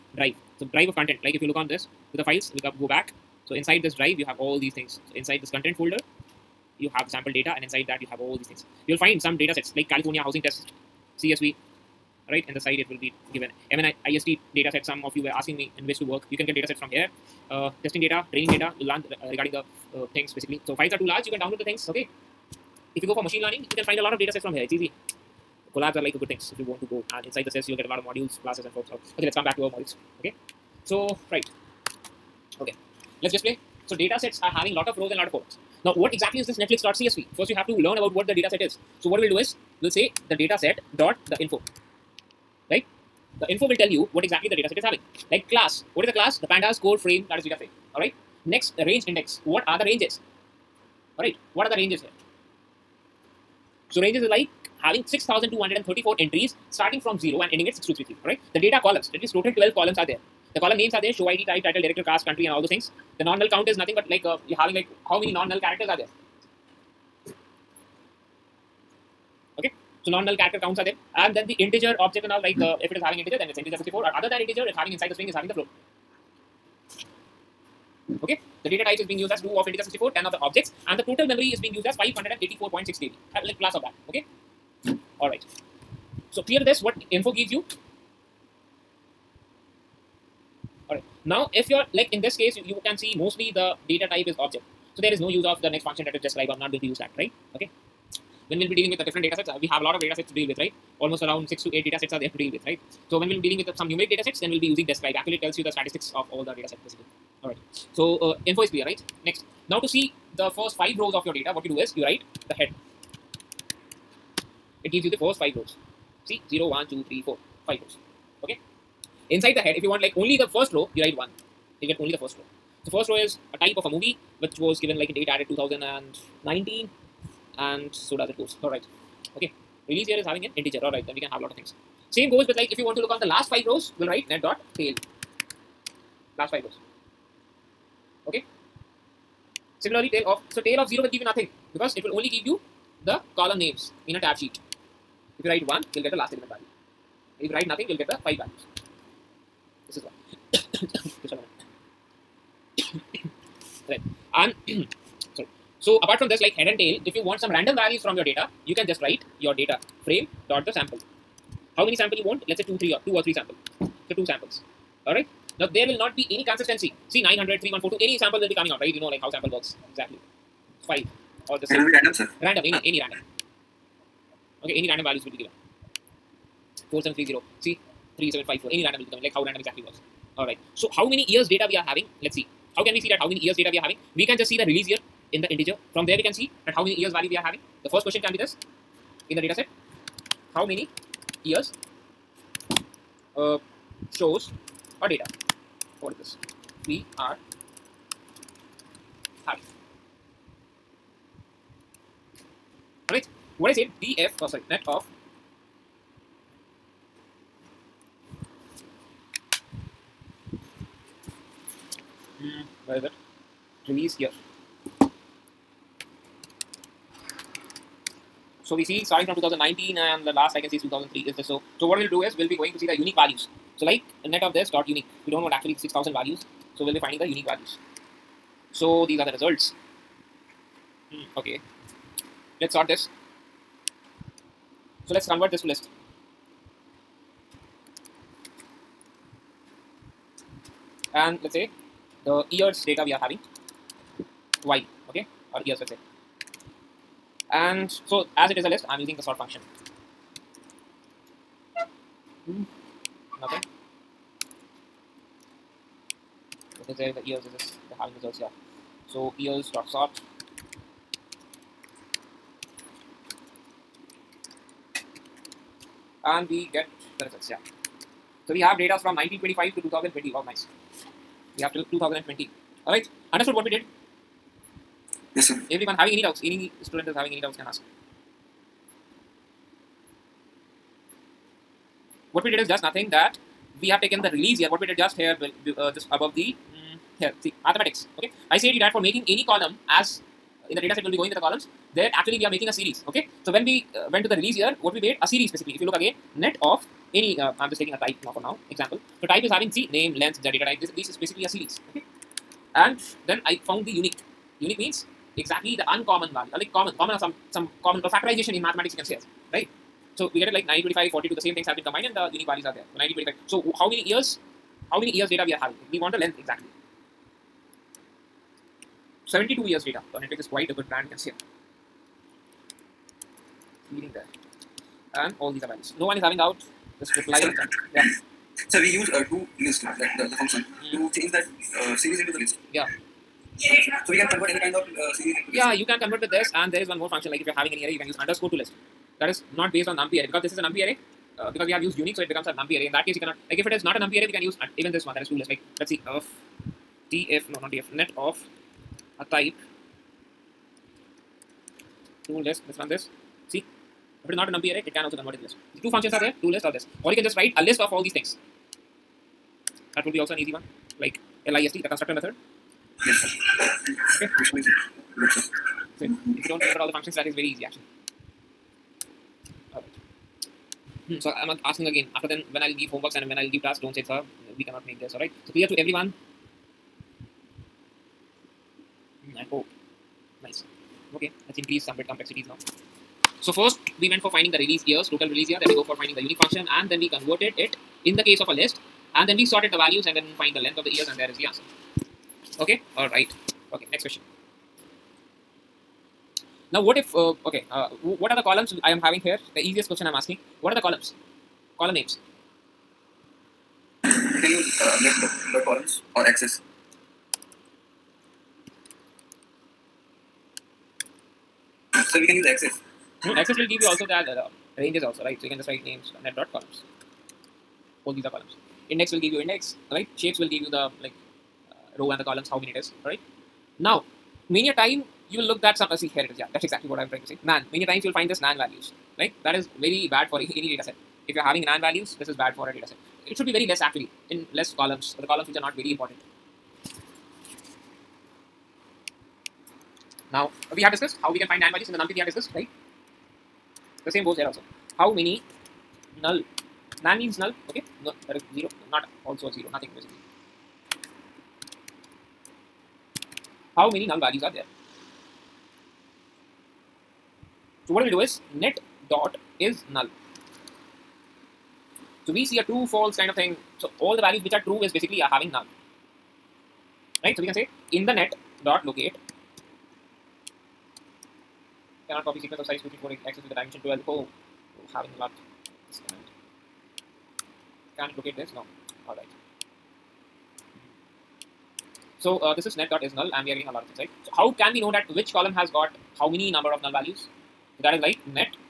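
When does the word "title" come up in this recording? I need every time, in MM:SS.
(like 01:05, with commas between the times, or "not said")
01:01.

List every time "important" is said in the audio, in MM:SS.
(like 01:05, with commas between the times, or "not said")
07:15.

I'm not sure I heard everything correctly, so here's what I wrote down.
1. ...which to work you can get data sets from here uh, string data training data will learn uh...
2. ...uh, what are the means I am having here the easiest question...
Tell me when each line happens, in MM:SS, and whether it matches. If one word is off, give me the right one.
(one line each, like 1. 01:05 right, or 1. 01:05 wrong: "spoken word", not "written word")
1. 00:15 wrong: "testing", not "string"
2. 06:37 wrong: "columns", not "means".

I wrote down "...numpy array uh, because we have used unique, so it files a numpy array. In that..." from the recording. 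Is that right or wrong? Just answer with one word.
wrong.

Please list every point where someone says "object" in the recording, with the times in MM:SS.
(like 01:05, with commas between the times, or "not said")
01:11, 01:20, 01:34.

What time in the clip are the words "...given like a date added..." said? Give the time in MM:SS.
02:04.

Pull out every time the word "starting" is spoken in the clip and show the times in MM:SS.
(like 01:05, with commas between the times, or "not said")
00:56, 03:39.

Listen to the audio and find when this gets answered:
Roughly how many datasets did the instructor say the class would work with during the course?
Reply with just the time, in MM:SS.
01:41.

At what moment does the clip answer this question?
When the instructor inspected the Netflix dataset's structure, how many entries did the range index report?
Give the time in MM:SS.
00:55.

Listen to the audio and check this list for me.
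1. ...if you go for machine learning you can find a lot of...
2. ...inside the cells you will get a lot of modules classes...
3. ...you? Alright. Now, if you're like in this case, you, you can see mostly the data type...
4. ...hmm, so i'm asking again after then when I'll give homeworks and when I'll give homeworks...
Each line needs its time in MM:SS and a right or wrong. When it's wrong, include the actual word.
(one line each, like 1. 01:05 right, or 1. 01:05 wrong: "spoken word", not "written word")
1. 00:22 right
2. 00:27 right
3. 01:27 right
4. 06:11 wrong: "tasks", not "homeworks".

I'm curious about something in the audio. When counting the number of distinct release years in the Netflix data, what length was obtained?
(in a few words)
72.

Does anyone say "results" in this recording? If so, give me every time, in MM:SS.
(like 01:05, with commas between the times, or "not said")
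03:49, 04:18, 04:27.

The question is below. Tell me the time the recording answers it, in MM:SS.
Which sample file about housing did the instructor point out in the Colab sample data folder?
00:09.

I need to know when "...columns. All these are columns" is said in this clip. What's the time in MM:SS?
06:56.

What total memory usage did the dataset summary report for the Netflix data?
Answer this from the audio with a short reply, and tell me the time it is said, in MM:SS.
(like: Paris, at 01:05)
584.6 KB, at 01:21.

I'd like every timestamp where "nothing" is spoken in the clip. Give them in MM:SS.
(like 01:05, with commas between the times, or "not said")
01:03, 02:21, 02:27, 04:13, 04:42, 07:29.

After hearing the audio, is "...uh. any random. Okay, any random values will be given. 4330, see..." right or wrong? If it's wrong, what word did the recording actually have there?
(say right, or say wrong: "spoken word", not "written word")
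wrong: "4730", not "4330".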